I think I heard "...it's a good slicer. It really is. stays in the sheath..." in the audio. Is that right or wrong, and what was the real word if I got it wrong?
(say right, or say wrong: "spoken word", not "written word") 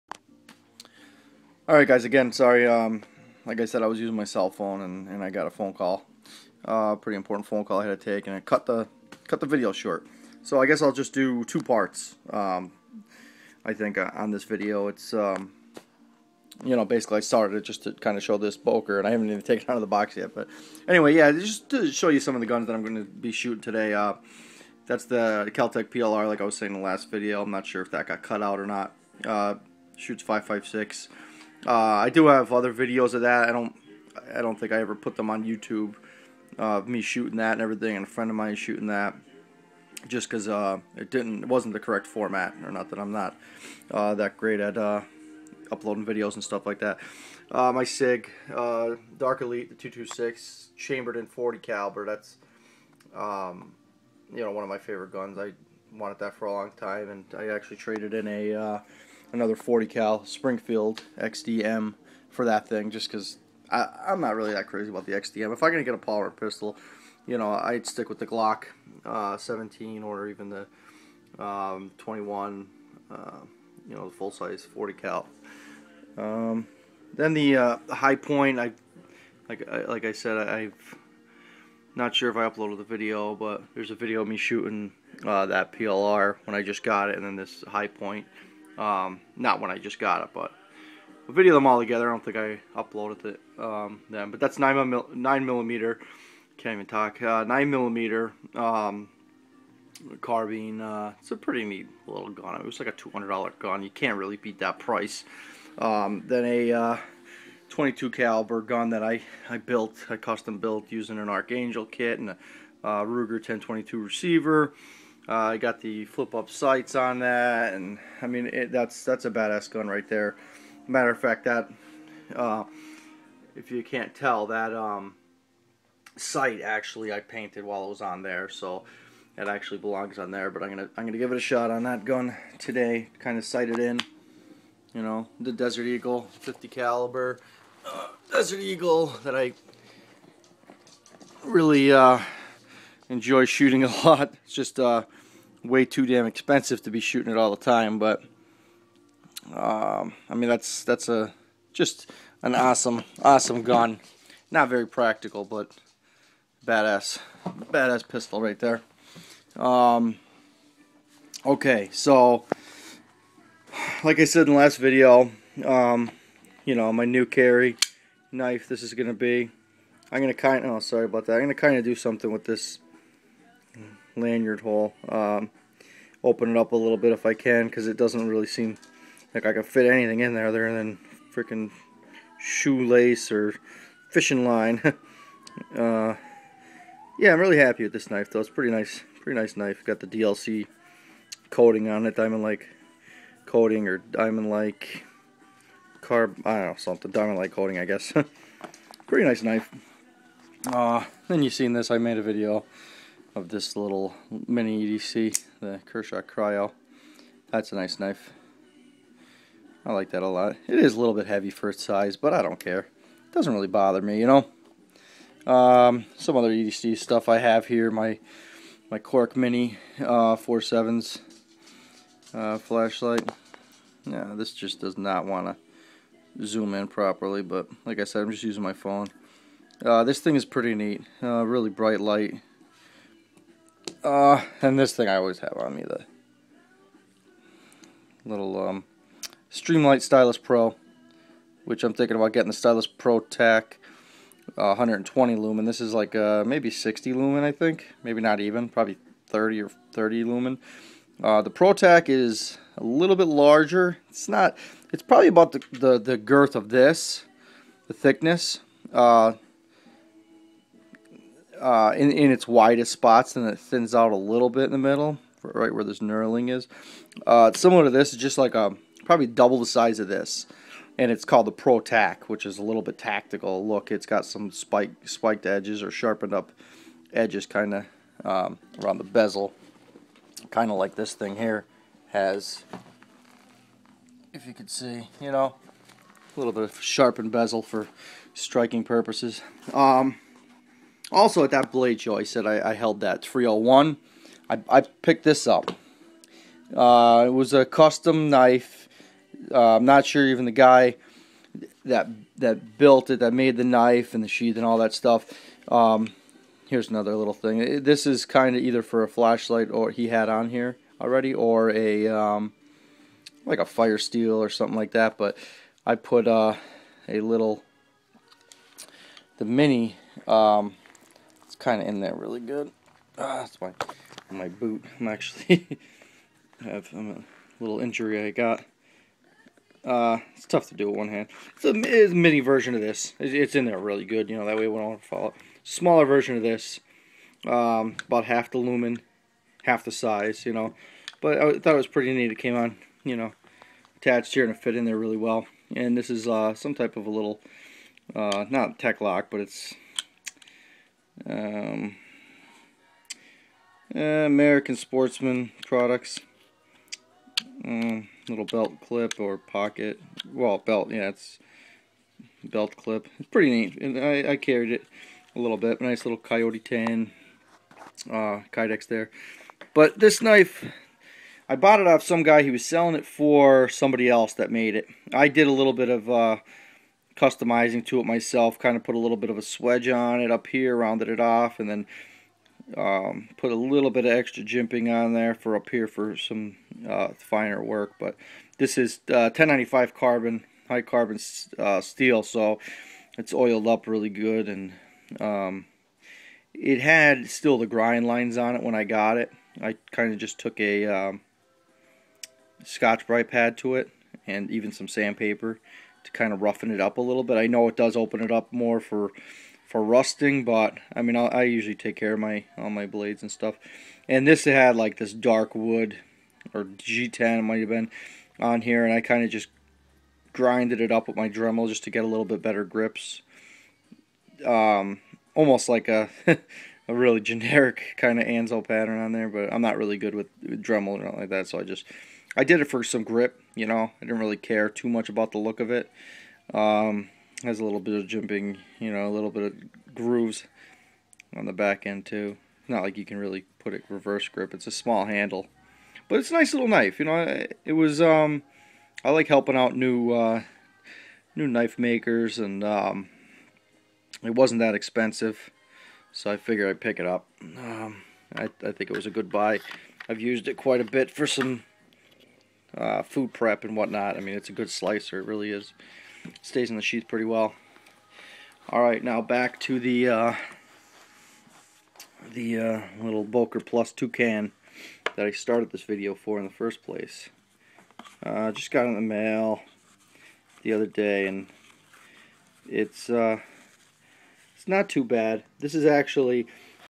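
right.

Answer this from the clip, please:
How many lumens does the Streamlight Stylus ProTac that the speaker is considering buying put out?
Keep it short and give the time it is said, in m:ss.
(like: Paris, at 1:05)
120 lumens, at 4:04.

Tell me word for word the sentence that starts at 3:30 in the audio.
It is a little bit heavy for its size, but I don't care.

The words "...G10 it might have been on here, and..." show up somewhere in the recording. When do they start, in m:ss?
6:56.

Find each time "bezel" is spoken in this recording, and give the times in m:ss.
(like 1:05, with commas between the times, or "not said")
4:39, 4:47.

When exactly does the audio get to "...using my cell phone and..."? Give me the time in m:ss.
0:03.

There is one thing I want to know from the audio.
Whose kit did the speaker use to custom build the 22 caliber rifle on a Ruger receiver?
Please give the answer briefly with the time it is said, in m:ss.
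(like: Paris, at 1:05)
Archangel, at 1:51.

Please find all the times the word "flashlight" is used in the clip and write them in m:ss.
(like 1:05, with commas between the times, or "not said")
3:42, 5:09.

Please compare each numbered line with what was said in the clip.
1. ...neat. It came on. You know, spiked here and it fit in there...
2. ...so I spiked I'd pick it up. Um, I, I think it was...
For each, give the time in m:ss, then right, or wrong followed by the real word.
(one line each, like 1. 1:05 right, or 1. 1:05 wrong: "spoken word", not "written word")
1. 5:42 wrong: "attached", not "spiked"
2. 7:36 wrong: "figured", not "spiked".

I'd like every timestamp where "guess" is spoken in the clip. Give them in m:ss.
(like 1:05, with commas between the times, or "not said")
0:10, 3:17.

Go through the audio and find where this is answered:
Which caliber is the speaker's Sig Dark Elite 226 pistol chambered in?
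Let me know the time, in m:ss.
0:51.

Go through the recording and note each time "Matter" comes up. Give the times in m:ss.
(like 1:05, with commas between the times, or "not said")
2:00.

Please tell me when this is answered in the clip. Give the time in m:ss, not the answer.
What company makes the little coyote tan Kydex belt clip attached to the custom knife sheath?
5:54.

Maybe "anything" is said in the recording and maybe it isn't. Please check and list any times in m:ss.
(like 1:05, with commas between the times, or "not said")
2:59, 7:11.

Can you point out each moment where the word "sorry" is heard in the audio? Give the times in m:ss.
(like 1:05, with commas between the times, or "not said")
0:02, 2:50.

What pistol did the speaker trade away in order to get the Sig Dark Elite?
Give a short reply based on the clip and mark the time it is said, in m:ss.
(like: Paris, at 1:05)
Springfield XDM, at 1:00.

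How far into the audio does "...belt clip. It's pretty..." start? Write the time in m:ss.
6:02.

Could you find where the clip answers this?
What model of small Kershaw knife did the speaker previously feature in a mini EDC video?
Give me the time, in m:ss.
3:25.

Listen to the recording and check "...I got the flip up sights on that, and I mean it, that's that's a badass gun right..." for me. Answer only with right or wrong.
right.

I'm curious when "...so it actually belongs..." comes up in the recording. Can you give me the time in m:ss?
2:08.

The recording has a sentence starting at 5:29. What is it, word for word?
Uh, it's tough to do with one hand.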